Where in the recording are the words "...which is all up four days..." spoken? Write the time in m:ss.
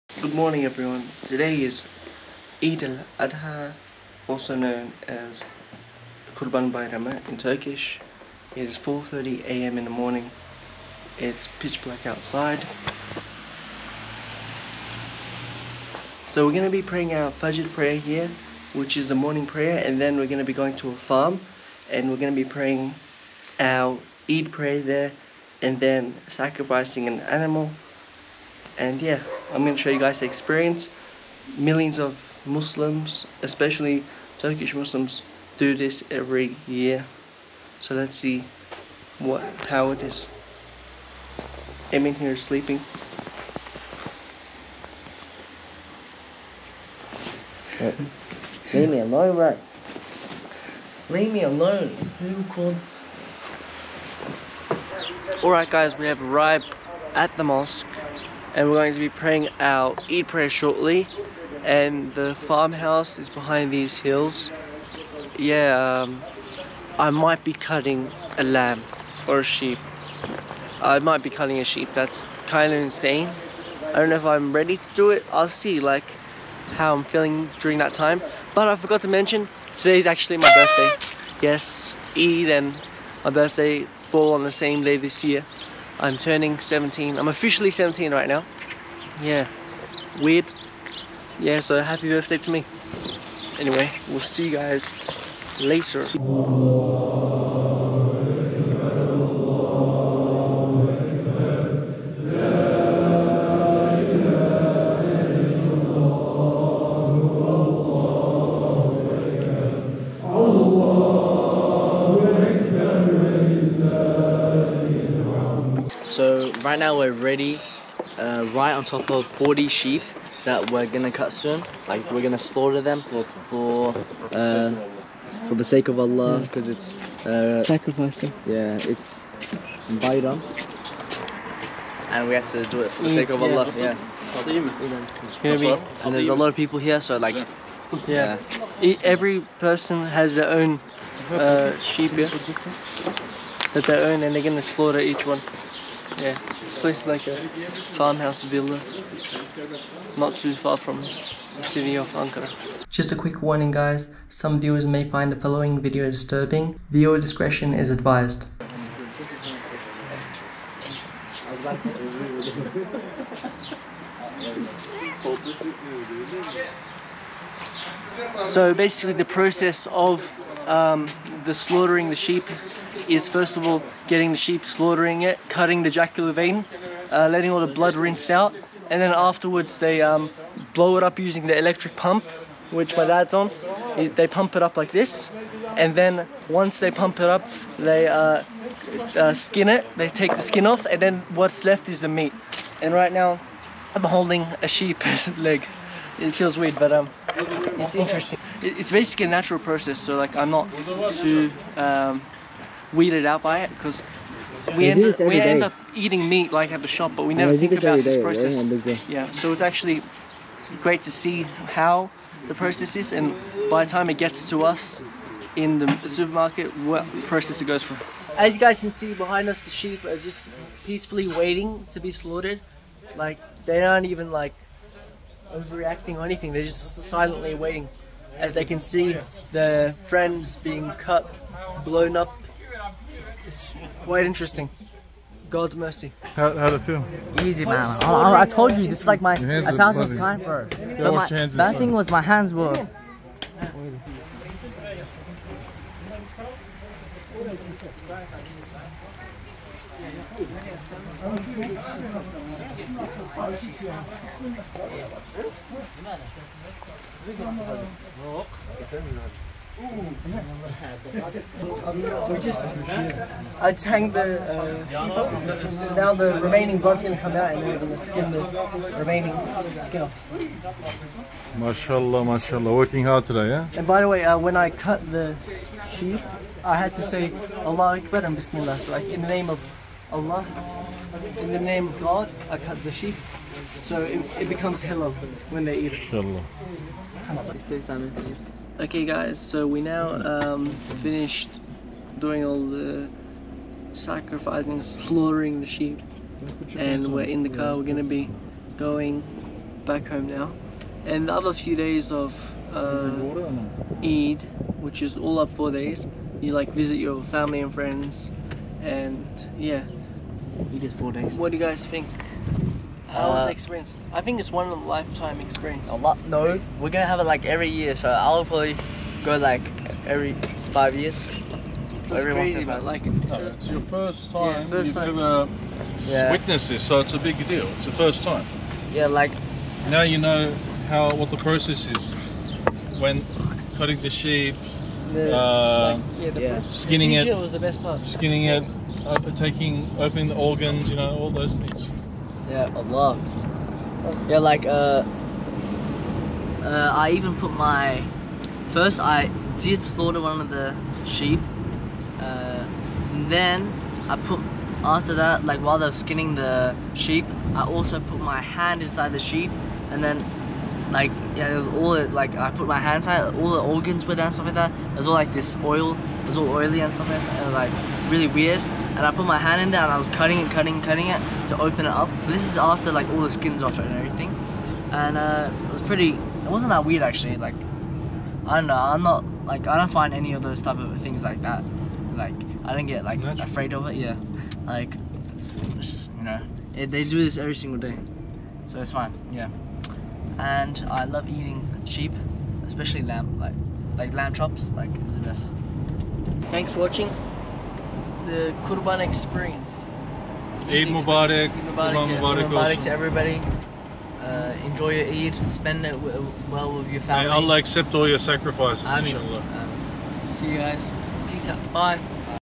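5:04.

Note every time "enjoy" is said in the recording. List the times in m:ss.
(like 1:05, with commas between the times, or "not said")
6:44.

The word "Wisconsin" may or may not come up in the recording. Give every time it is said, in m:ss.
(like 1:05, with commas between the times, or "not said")
not said.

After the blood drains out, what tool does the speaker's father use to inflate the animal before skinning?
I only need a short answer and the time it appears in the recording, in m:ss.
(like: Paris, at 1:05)
electric pump, at 3:01.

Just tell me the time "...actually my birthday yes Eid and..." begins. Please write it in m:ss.
1:20.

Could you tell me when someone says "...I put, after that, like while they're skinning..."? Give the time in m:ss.
5:54.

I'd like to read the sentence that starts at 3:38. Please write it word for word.
As you guys can see behind us, the sheep are just peacefully waiting to be slaughtered.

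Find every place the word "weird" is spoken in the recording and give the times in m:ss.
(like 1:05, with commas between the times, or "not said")
1:30, 3:16, 6:08, 6:16.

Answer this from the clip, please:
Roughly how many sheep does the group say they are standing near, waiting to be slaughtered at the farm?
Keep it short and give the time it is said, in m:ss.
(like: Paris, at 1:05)
40, at 1:59.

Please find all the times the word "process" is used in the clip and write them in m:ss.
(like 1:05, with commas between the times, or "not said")
2:49, 3:19, 3:28, 3:32, 3:37, 5:31.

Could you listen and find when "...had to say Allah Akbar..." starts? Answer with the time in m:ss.
4:36.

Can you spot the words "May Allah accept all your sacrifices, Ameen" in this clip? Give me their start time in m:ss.
6:47.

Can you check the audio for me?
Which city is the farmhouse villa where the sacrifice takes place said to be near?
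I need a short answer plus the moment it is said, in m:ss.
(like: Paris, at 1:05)
Ankara, at 2:32.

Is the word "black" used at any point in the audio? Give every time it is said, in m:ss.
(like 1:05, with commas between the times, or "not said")
0:11.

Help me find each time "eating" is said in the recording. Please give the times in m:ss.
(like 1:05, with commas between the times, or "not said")
3:25, 6:31.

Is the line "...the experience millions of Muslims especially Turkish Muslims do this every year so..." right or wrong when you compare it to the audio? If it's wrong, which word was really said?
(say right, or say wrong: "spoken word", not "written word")
right.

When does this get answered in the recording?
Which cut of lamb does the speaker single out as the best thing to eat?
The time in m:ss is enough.
6:34.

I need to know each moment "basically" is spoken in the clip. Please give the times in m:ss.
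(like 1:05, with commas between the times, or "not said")
2:48, 3:18.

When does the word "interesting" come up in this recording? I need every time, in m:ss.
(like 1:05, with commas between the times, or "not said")
3:17, 3:54.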